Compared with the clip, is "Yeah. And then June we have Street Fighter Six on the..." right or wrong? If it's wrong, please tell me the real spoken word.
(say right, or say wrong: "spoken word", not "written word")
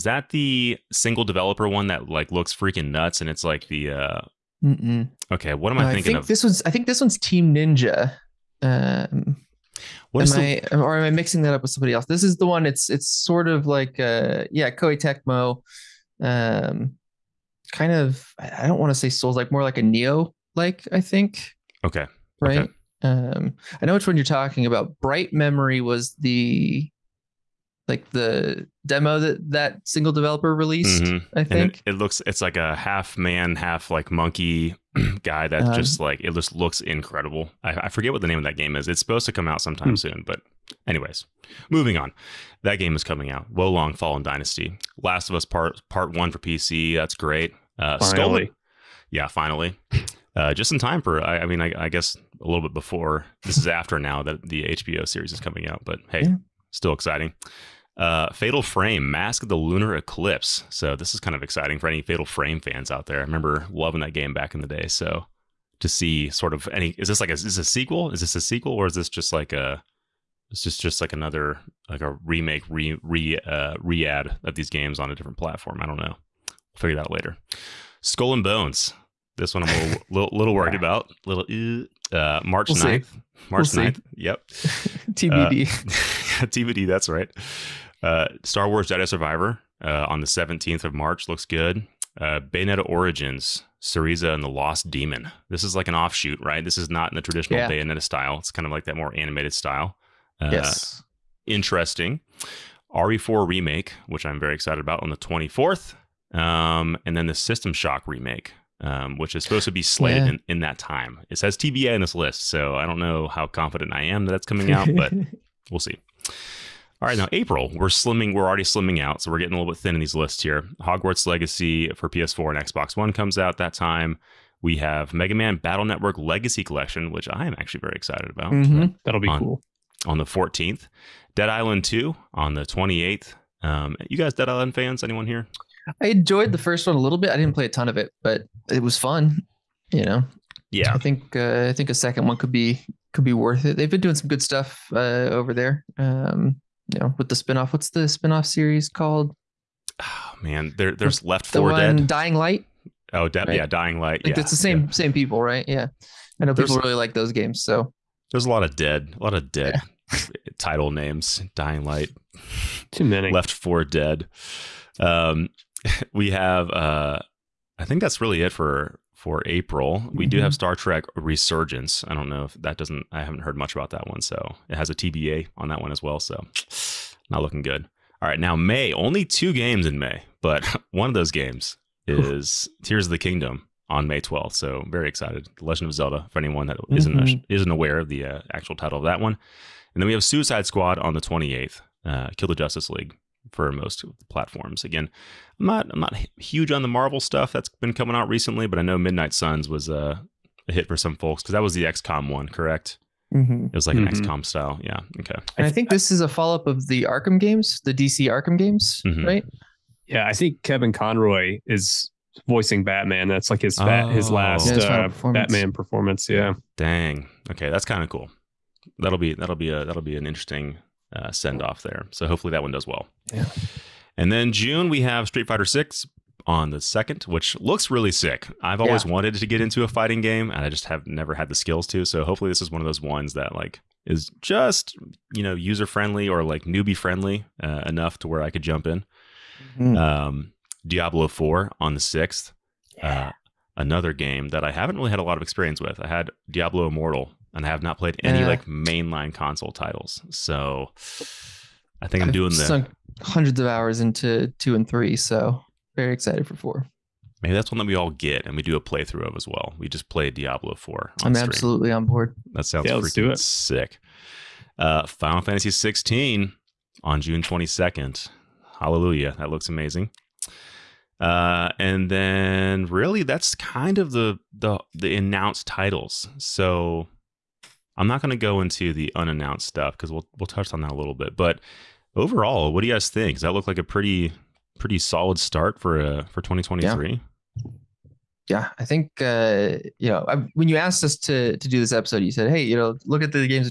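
right.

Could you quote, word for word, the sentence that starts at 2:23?
They've been doing some good stuff uh, over there.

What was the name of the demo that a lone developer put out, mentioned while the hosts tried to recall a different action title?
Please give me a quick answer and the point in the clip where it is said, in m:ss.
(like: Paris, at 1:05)
Bright Memory, at 0:24.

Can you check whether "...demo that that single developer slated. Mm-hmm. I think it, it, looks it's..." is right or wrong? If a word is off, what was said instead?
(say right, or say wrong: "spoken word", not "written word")
wrong: "released", not "slated".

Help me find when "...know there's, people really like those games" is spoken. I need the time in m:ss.
2:36.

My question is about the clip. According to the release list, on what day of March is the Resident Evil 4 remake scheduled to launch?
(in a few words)
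24th.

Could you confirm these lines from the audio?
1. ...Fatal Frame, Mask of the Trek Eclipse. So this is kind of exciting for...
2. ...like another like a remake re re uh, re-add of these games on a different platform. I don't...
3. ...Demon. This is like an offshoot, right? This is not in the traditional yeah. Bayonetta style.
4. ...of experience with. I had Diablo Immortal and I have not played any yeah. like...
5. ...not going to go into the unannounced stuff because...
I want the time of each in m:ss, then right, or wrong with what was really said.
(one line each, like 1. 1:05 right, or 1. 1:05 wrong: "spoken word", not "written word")
1. 0:58 wrong: "Lunar", not "Trek"
2. 1:11 right
3. 1:34 right
4. 4:05 right
5. 4:38 right.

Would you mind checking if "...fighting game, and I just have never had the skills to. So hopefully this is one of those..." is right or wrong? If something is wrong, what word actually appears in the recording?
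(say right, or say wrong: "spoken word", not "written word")
right.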